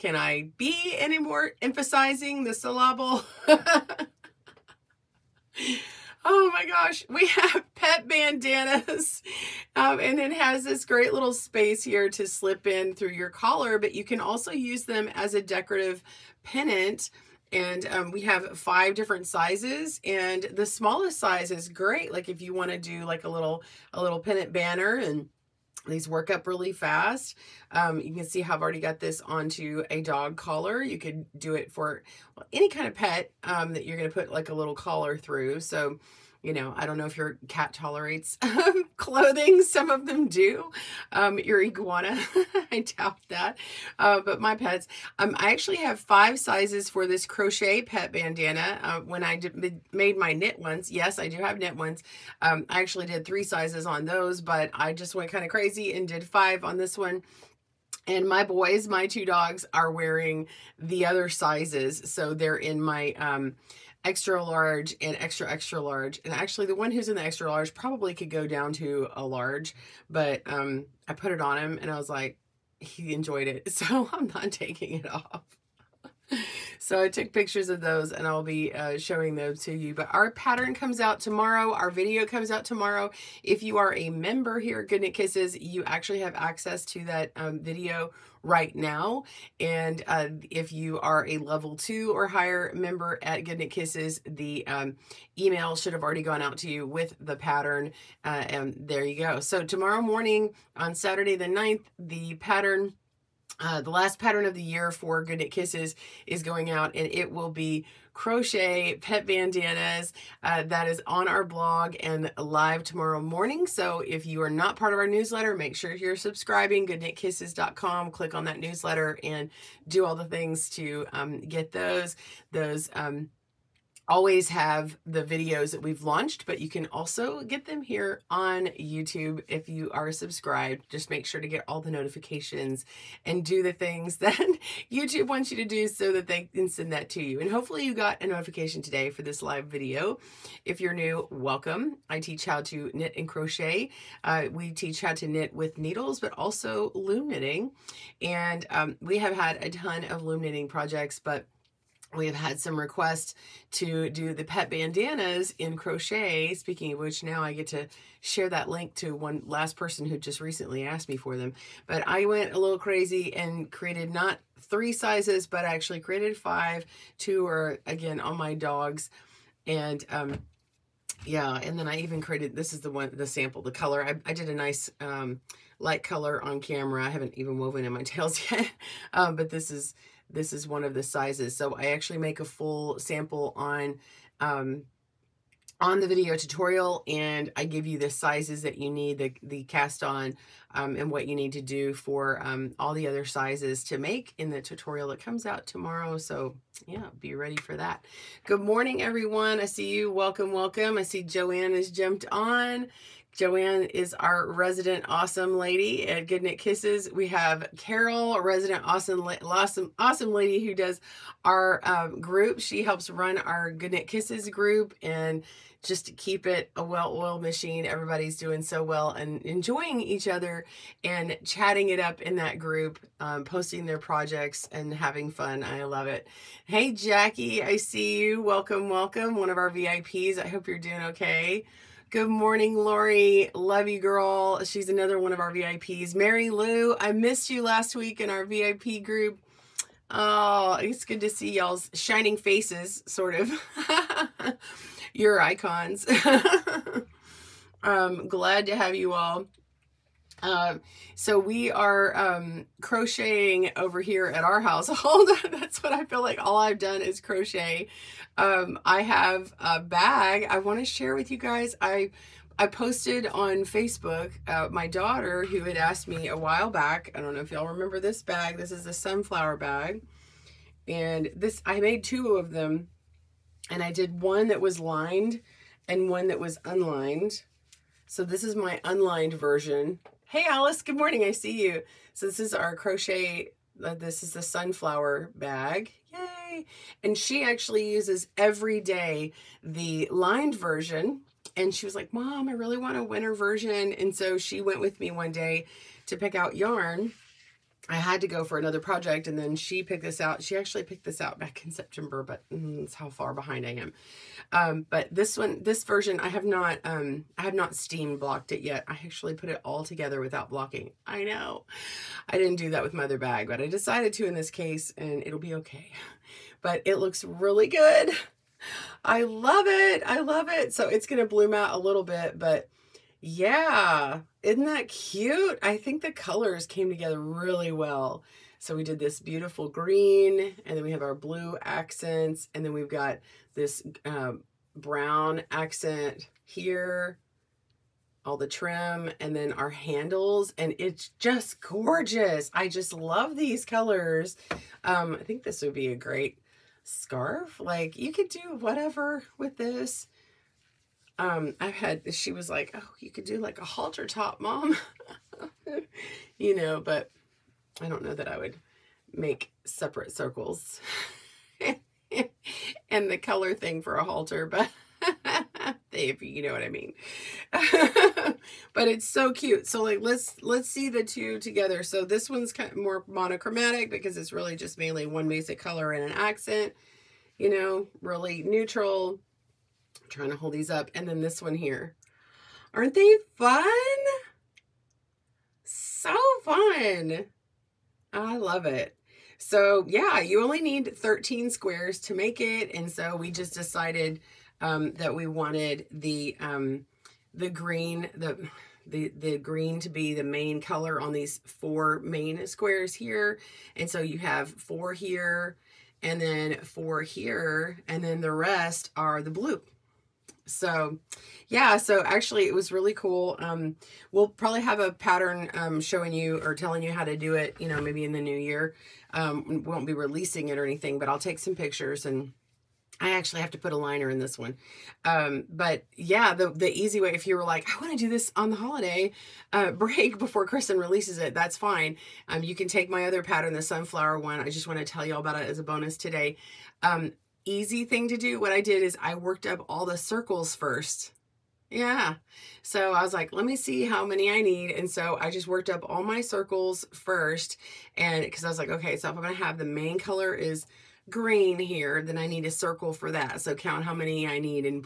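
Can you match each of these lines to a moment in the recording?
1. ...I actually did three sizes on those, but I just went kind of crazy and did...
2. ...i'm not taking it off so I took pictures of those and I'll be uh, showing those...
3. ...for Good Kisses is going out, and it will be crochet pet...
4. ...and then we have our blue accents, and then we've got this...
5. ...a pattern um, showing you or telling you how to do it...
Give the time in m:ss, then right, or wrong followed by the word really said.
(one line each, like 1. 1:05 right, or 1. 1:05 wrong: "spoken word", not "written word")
1. 0:52 right
2. 1:14 right
3. 1:44 right
4. 5:30 right
5. 6:54 right.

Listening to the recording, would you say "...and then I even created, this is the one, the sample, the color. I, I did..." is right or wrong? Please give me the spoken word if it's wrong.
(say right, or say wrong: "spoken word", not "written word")
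right.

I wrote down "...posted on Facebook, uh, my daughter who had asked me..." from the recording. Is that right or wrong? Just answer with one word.
right.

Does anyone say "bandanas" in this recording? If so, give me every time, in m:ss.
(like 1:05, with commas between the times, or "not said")
0:08, 0:48, 1:49, 2:34.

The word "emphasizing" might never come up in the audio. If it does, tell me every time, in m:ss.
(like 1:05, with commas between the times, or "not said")
0:01.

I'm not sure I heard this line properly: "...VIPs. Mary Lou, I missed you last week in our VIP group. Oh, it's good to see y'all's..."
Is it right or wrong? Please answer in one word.
right.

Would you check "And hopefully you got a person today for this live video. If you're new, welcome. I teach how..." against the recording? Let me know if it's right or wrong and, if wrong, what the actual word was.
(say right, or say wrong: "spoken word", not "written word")
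wrong: "notification", not "person".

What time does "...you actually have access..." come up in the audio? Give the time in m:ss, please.
1:25.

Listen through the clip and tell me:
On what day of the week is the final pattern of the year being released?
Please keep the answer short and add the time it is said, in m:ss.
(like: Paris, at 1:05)
Saturday, at 1:40.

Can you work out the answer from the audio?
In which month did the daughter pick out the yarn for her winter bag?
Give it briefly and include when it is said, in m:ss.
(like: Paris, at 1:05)
September, at 5:01.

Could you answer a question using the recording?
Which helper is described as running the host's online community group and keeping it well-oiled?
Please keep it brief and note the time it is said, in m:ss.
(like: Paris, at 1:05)
Carol, at 3:27.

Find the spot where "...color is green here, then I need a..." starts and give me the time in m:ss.
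7:29.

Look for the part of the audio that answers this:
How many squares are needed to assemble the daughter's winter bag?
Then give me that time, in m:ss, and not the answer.
6:30.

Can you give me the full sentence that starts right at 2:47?
Two are, again, on my dogs.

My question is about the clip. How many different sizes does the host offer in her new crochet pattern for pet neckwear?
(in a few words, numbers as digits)
5.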